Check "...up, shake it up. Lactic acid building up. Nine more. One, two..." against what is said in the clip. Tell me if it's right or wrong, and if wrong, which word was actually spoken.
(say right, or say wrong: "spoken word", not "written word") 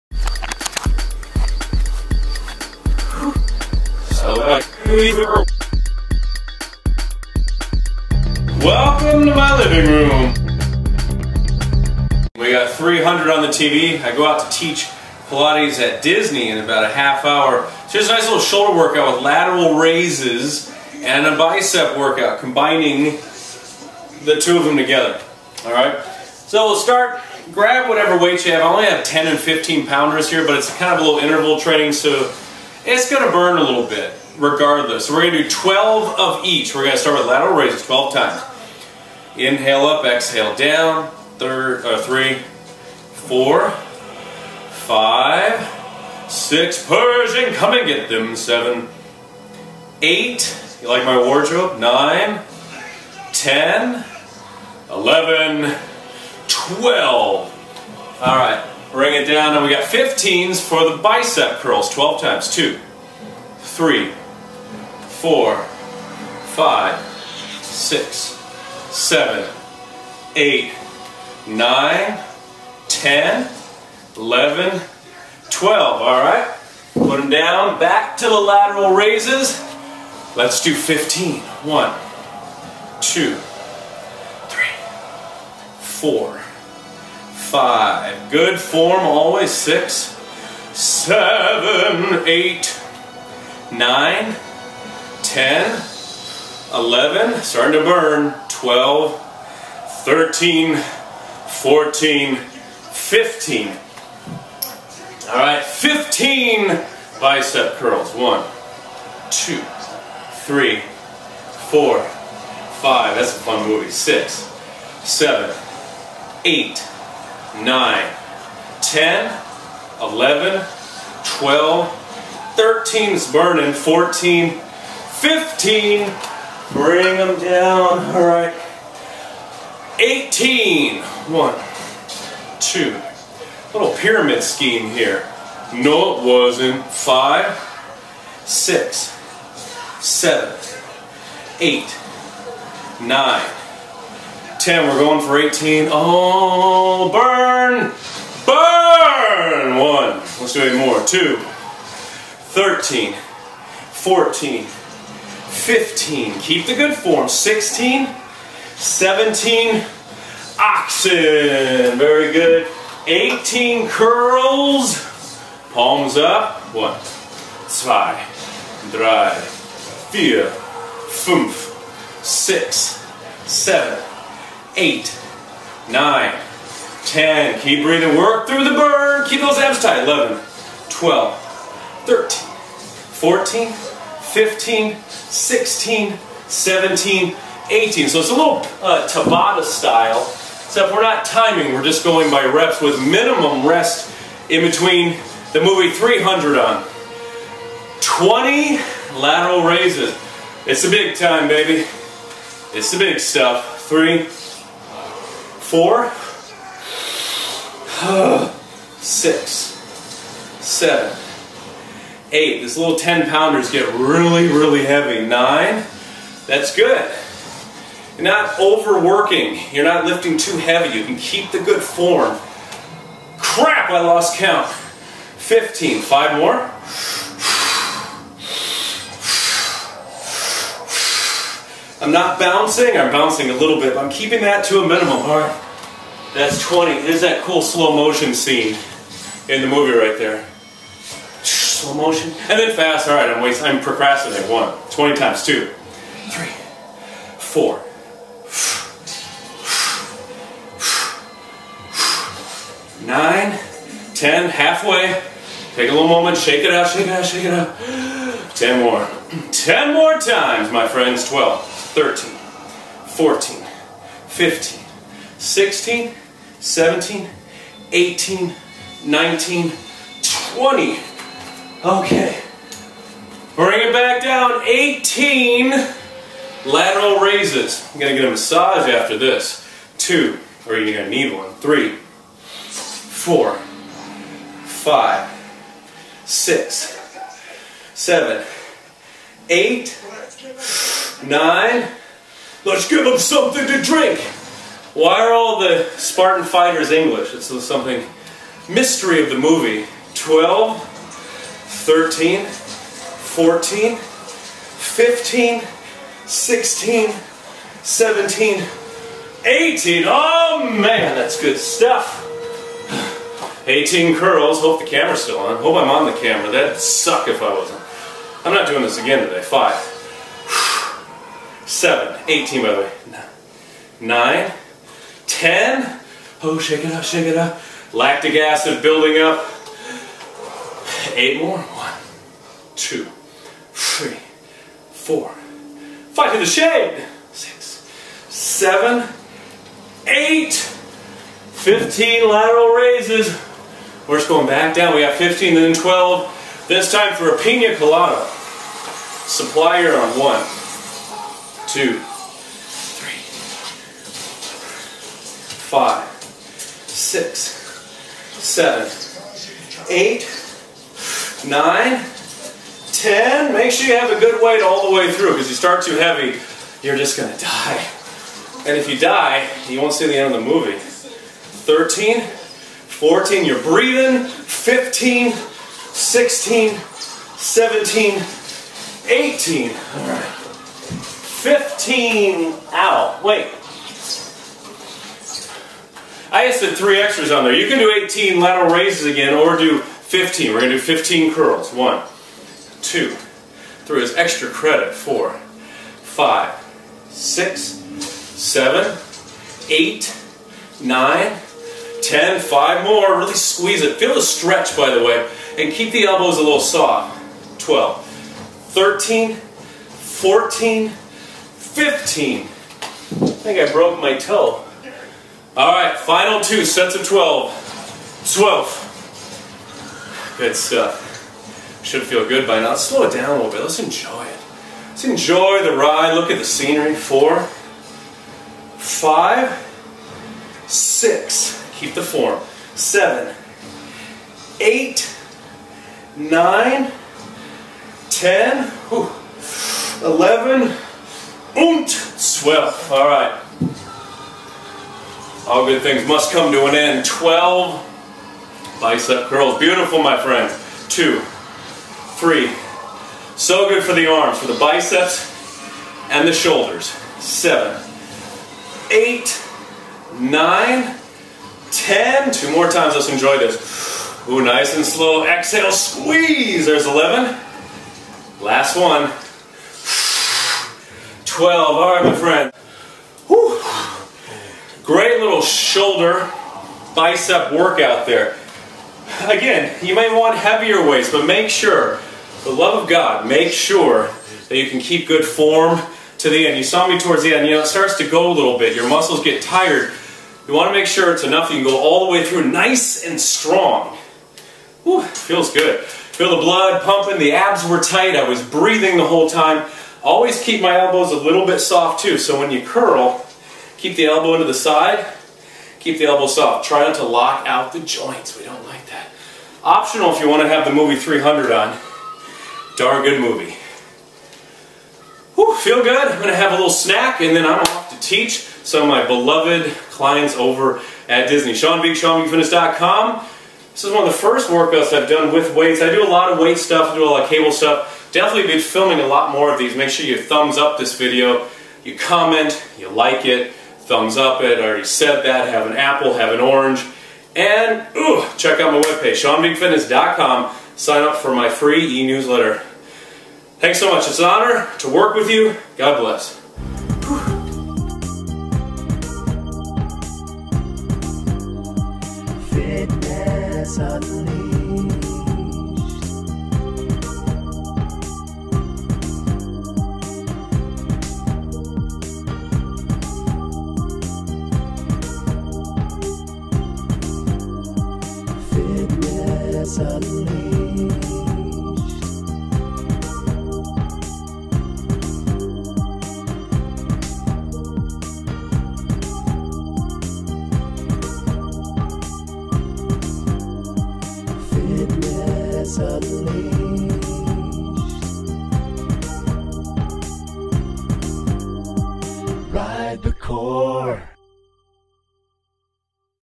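wrong: "Eight", not "Nine".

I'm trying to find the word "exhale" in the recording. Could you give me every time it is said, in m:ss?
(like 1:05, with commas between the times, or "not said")
0:40, 7:45.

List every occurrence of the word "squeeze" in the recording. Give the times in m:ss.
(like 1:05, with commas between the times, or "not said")
6:43, 7:45.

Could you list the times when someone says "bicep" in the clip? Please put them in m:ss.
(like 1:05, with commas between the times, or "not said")
0:21, 1:01, 1:47, 7:28, 7:34, 7:56.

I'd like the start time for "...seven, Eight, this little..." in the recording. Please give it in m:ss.
3:30.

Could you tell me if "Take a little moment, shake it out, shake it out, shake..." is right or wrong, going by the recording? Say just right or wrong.
right.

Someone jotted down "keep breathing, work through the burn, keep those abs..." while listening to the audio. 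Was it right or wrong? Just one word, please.
right.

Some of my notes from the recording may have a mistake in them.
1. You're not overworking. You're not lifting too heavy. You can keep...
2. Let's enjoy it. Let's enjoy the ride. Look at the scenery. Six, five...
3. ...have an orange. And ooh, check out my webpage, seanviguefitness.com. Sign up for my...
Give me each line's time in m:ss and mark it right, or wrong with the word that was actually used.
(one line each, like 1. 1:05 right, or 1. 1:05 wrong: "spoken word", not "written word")
1. 3:38 right
2. 7:03 wrong: "Four", not "Six"
3. 8:56 right.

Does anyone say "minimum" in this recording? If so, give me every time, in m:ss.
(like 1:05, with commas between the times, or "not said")
3:13, 3:54.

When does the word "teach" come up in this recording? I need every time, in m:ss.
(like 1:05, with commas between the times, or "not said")
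0:14, 8:37.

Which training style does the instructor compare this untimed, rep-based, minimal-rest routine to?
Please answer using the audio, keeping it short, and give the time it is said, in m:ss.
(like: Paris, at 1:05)
Tabata, at 3:09.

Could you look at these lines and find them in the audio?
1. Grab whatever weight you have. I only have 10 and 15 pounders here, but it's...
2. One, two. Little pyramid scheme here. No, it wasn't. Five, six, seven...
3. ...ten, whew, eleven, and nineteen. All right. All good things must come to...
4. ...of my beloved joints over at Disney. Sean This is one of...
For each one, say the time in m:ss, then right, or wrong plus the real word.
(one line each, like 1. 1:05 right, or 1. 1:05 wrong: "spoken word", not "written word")
1. 0:27 right
2. 2:11 right
3. 7:18 wrong: "twelve", not "nineteen"
4. 8:38 wrong: "clients", not "joints".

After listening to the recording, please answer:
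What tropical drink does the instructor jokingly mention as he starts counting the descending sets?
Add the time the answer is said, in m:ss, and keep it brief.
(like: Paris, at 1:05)
Pina colada, at 5:47.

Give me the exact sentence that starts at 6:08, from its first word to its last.
And if you die, you won't see the end of the movie.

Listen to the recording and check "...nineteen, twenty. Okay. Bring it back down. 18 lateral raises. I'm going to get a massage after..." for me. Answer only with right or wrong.
right.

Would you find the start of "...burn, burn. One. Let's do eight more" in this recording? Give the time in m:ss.
2:27.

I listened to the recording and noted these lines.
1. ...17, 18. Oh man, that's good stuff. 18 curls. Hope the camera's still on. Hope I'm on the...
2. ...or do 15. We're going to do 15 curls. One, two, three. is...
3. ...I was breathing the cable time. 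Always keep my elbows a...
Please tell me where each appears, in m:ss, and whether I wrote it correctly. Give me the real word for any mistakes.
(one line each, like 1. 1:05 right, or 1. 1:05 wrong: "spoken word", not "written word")
1. 5:07 right
2. 6:29 right
3. 8:18 wrong: "whole", not "cable".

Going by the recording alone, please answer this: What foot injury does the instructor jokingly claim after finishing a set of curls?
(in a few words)
Broke my toe.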